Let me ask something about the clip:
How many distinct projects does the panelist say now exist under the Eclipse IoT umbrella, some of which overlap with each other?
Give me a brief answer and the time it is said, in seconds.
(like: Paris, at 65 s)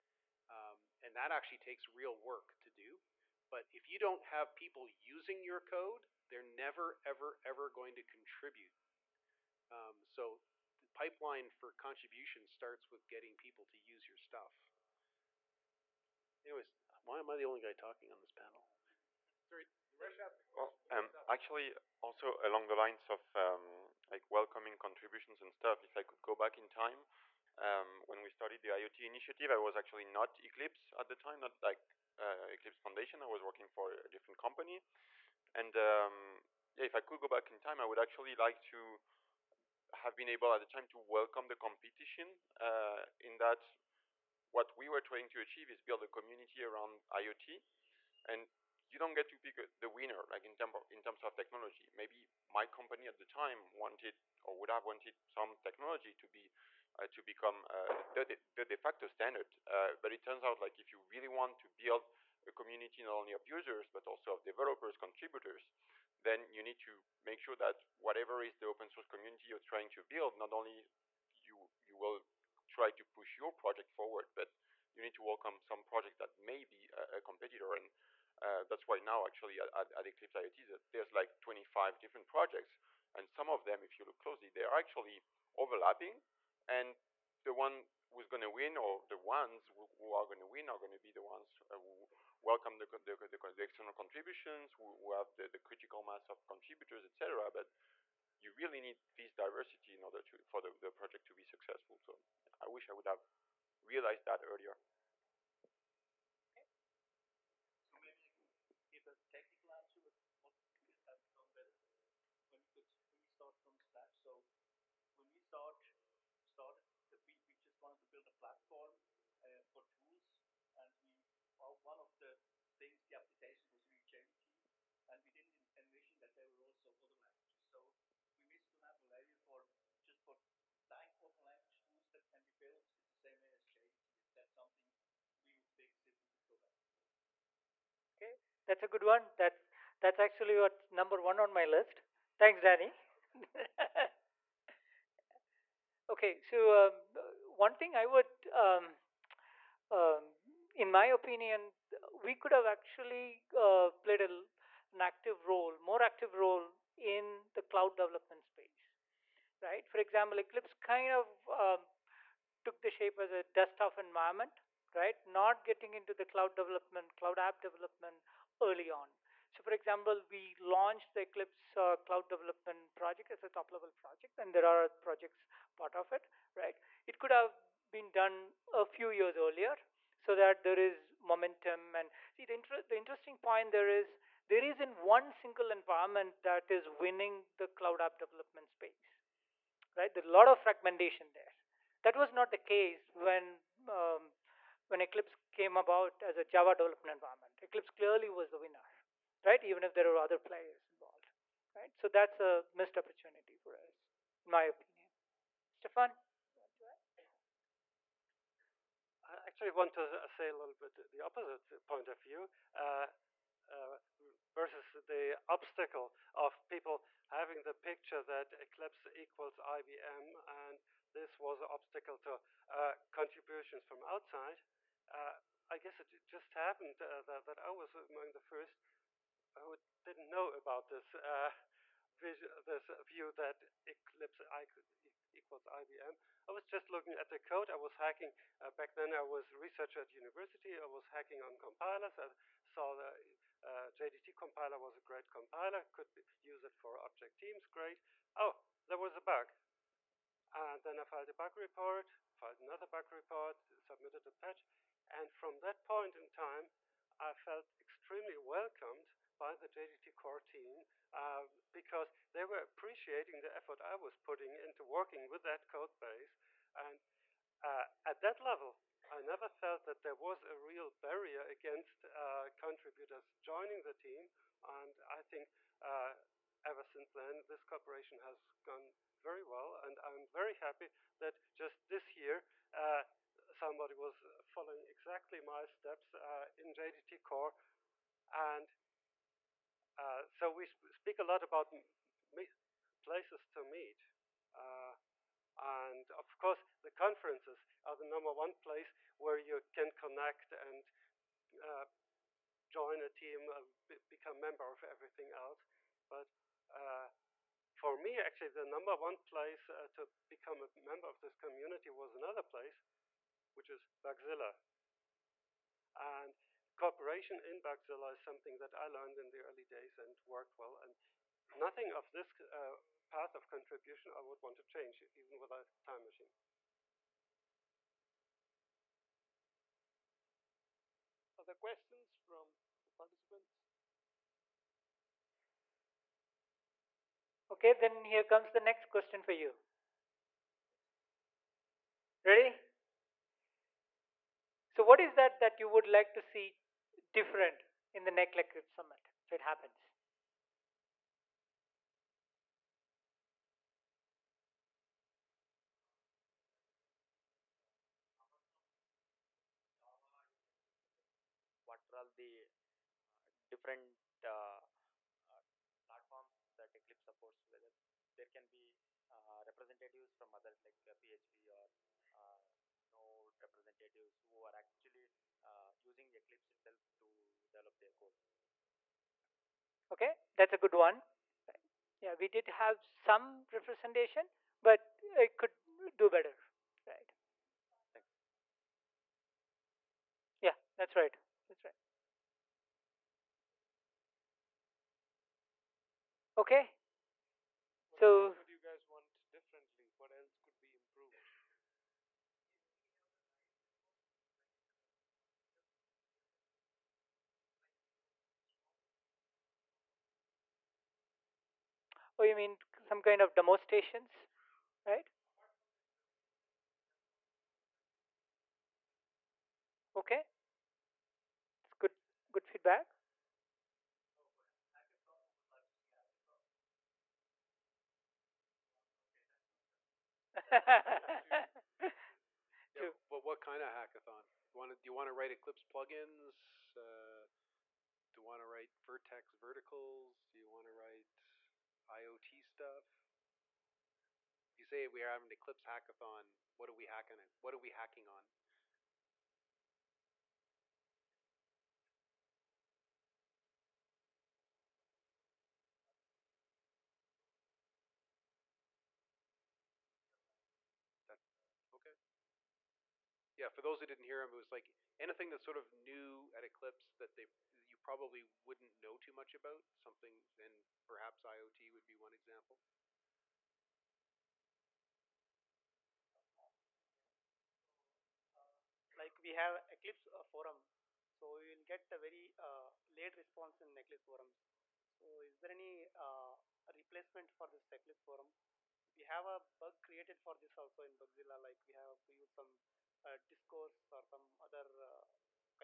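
25, at 81 s.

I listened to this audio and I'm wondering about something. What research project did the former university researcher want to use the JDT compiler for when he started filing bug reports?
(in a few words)
object teams.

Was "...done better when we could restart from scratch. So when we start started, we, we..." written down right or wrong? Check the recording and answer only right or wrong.
right.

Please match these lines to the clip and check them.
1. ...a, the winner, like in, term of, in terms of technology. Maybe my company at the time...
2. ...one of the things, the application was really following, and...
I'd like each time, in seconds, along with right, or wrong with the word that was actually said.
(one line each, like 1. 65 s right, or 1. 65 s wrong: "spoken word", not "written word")
1. 49 s right
2. 121 s wrong: "changing", not "following".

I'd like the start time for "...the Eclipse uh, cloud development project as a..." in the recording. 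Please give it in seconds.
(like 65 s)
171 s.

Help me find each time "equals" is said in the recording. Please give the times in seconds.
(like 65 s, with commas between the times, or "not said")
219 s, 235 s.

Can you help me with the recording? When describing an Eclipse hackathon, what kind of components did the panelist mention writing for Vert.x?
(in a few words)
verticles.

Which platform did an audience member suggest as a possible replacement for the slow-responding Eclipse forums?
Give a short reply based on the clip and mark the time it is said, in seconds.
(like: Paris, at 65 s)
Discourse, at 493 s.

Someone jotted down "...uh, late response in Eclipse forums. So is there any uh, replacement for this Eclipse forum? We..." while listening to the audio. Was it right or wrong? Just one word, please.
right.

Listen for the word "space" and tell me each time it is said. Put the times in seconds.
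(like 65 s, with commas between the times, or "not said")
158 s, 188 s.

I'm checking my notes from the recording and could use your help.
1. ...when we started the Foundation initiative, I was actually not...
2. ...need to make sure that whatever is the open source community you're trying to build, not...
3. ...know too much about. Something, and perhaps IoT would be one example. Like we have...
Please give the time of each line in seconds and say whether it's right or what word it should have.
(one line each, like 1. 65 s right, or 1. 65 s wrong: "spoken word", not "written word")
1. 28 s wrong: "IoT", not "Foundation"
2. 66 s right
3. 468 s right.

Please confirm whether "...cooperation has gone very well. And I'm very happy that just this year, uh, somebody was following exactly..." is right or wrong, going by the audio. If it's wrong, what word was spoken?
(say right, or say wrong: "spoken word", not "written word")
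right.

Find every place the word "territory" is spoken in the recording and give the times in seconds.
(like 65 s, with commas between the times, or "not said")
not said.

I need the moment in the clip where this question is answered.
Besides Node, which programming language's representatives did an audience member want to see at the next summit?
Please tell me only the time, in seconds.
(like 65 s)
371 s.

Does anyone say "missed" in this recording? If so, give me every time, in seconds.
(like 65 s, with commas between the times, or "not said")
128 s, 202 s.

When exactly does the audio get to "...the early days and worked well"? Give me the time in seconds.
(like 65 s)
319 s.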